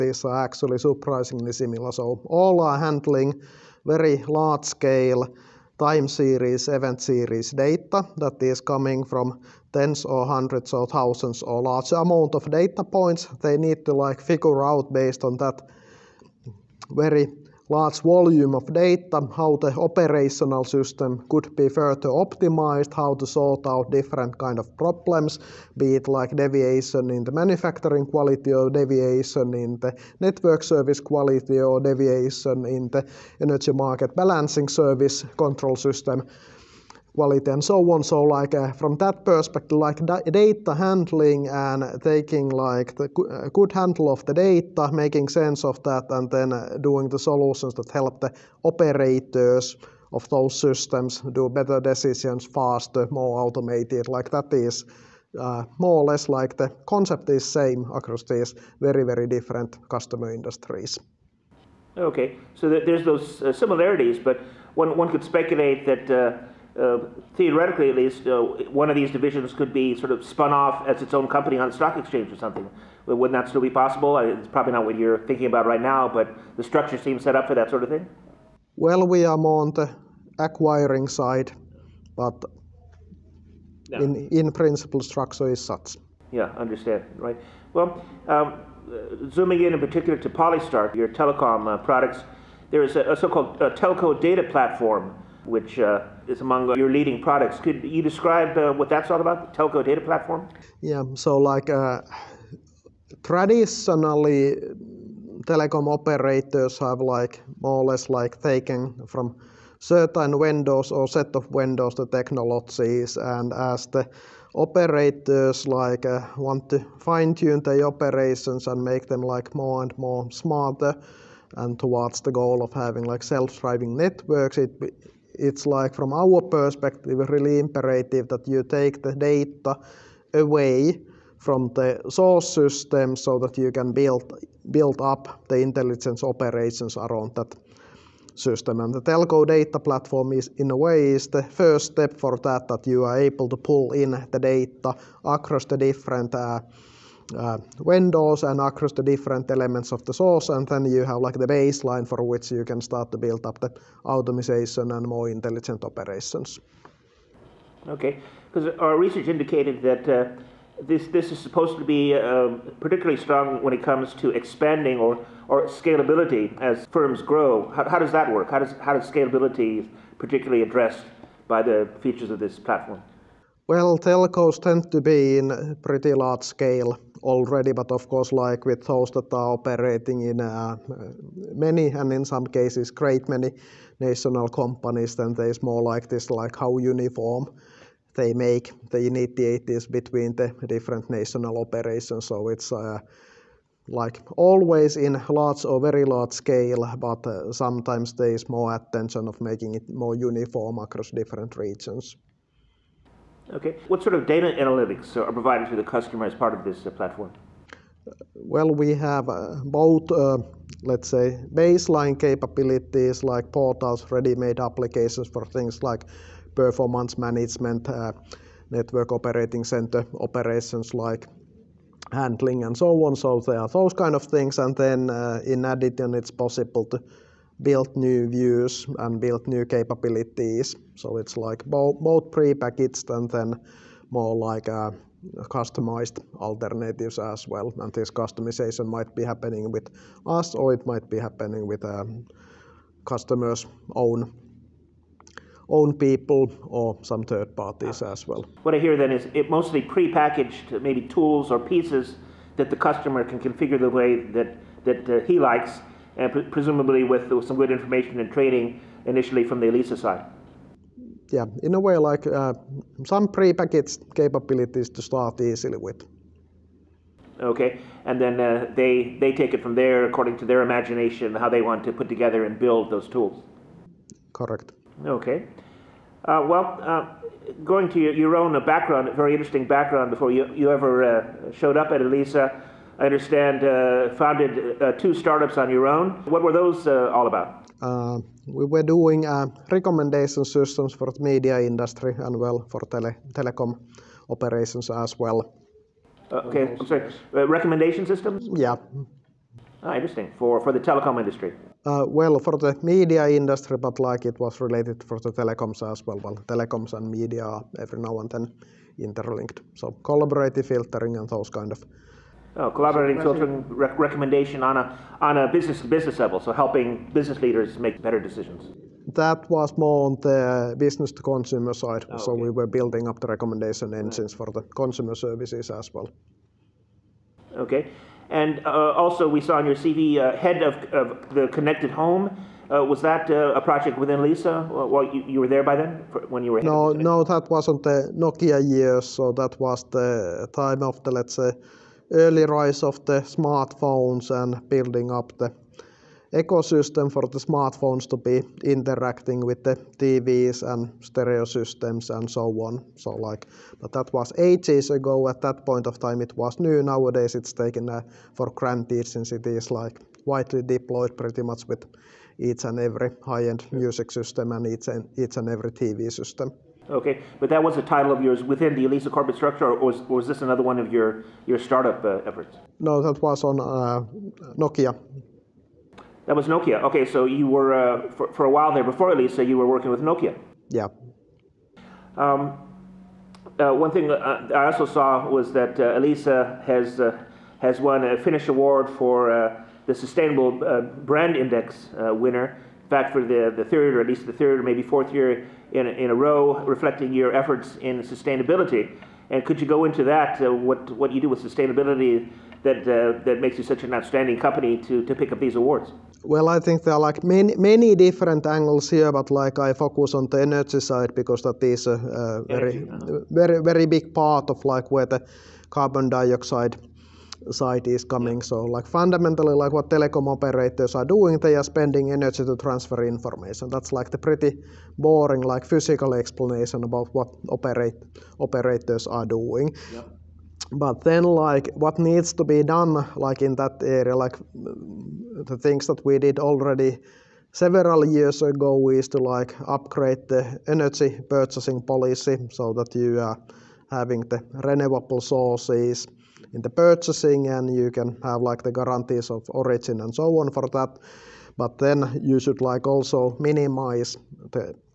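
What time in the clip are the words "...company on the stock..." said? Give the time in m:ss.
1:11.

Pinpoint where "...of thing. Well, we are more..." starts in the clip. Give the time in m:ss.
1:17.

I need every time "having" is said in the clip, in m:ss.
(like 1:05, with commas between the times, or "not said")
2:02, 7:23.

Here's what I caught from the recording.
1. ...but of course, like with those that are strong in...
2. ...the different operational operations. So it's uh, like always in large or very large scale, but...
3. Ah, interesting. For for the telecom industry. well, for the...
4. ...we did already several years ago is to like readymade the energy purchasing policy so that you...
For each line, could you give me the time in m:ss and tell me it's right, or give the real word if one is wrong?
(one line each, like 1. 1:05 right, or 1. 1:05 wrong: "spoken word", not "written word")
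1. 2:57 wrong: "operating", not "strong"
2. 3:10 wrong: "national", not "operational"
3. 4:59 right
4. 7:16 wrong: "upgrade", not "readymade".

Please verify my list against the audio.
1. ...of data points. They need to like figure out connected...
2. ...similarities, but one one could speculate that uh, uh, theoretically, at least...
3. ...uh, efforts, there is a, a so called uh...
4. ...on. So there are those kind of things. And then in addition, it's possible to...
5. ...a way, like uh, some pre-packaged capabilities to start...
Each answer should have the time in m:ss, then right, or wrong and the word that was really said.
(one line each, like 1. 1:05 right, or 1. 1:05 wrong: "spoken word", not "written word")
1. 0:12 wrong: "based", not "connected"
2. 1:03 right
3. 1:31 wrong: "products", not "efforts"
4. 3:43 right
5. 4:21 right.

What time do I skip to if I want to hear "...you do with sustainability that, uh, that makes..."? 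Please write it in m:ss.
6:41.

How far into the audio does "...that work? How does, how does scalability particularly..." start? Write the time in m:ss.
2:48.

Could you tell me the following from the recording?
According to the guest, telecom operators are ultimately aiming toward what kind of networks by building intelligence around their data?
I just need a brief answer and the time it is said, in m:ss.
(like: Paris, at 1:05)
Self-driving networks, at 2:03.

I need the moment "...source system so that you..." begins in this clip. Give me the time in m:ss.
2:12.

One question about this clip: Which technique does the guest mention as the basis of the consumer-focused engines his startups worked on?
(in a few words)
Collaborative filtering.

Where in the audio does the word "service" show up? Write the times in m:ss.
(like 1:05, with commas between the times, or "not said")
0:30, 0:34, 5:25.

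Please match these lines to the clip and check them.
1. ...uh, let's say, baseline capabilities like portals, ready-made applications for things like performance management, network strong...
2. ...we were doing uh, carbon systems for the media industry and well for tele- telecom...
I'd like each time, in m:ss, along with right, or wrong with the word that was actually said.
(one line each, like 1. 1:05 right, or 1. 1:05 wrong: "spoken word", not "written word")
1. 3:30 wrong: "operating", not "strong"
2. 4:48 wrong: "recommendation", not "carbon".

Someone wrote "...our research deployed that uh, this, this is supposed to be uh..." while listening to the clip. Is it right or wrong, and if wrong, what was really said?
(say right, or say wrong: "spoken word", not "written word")
wrong: "indicated", not "deployed".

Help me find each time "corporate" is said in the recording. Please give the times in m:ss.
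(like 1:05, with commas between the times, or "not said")
6:09.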